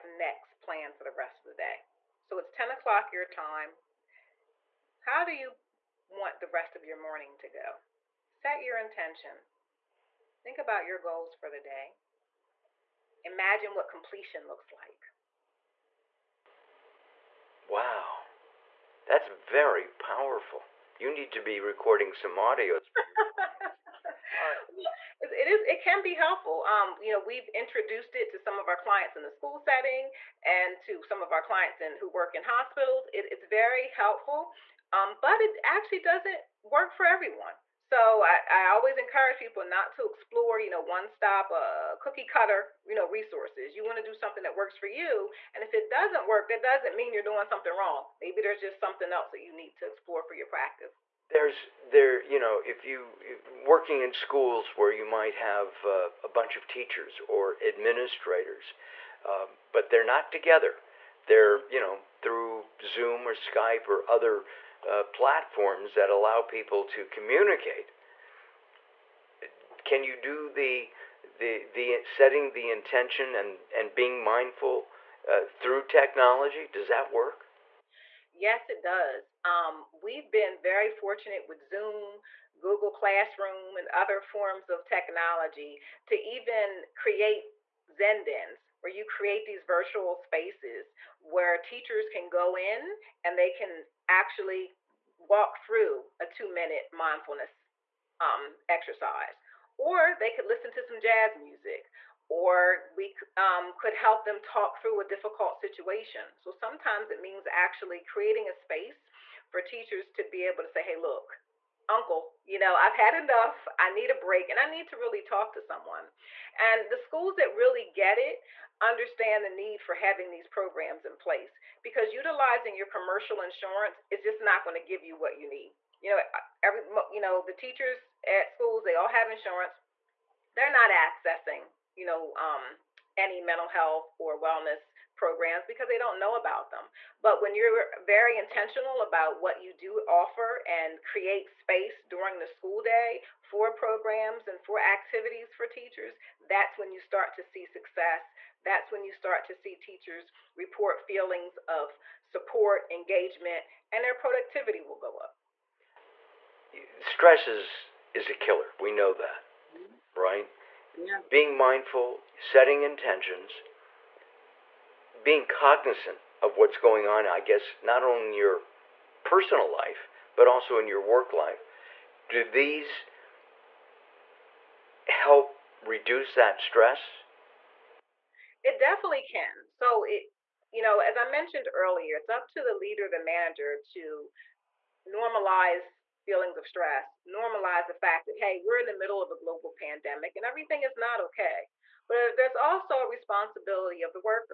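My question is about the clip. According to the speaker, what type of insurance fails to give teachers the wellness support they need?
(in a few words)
commercial insurance.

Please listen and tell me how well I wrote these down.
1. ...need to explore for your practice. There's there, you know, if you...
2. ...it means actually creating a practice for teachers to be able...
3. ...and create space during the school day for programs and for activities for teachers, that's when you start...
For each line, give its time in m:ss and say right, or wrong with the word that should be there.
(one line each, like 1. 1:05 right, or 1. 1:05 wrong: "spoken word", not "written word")
1. 0:49 right
2. 1:47 wrong: "space", not "practice"
3. 2:20 right.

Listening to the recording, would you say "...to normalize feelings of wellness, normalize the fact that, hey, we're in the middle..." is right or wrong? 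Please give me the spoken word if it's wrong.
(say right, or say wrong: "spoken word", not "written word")
wrong: "stress", not "wellness".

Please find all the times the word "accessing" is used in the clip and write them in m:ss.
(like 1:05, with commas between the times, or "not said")
2:10.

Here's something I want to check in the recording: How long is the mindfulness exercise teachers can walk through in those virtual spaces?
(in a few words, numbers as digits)
two minute.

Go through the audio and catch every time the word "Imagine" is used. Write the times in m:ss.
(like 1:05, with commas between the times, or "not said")
0:13.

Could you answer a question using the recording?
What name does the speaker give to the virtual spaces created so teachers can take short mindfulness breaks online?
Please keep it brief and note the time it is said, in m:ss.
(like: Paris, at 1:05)
Zendins, at 1:27.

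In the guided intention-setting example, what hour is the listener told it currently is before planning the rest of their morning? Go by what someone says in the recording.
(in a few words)
10 o'clock.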